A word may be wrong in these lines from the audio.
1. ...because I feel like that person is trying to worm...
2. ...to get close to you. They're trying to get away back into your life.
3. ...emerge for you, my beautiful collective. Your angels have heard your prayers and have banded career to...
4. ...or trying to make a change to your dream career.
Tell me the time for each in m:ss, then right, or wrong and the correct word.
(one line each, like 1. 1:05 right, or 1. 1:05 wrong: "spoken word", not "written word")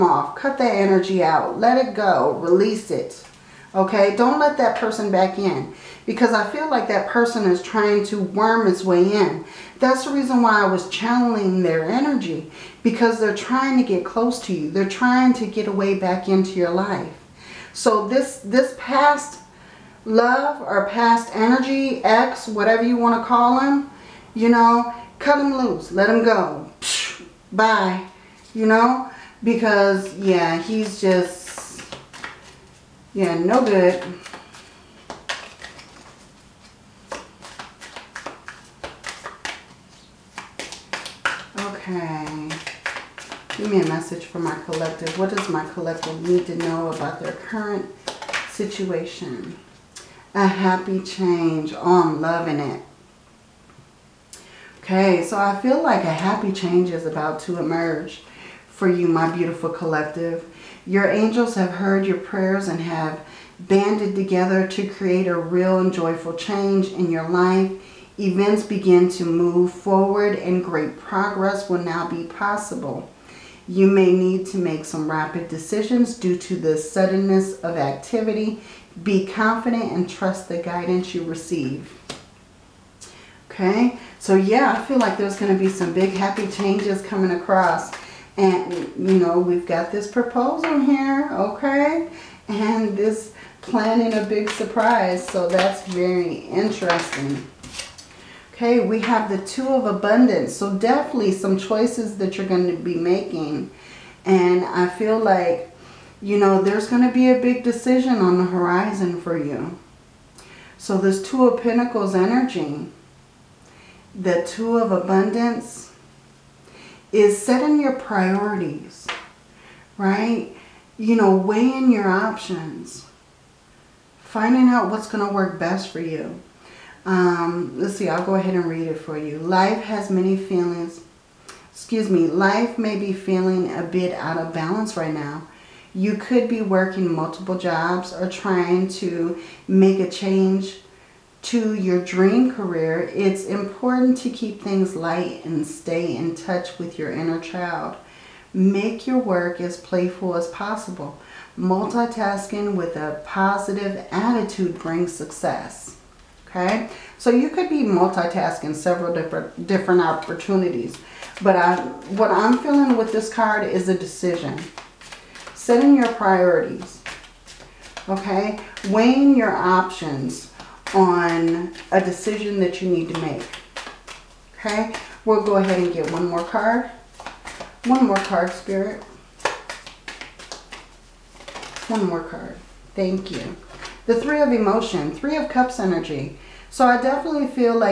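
1. 0:06 right
2. 0:13 right
3. 0:57 wrong: "together", not "career"
4. 2:18 right.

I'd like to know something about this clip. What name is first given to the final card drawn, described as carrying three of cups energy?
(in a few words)
Three of emotion.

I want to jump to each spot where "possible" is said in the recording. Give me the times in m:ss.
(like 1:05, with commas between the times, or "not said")
1:12, 2:30.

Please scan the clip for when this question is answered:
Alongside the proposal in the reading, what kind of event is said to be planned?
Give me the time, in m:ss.
1:34.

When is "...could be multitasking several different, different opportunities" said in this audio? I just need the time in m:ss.
2:37.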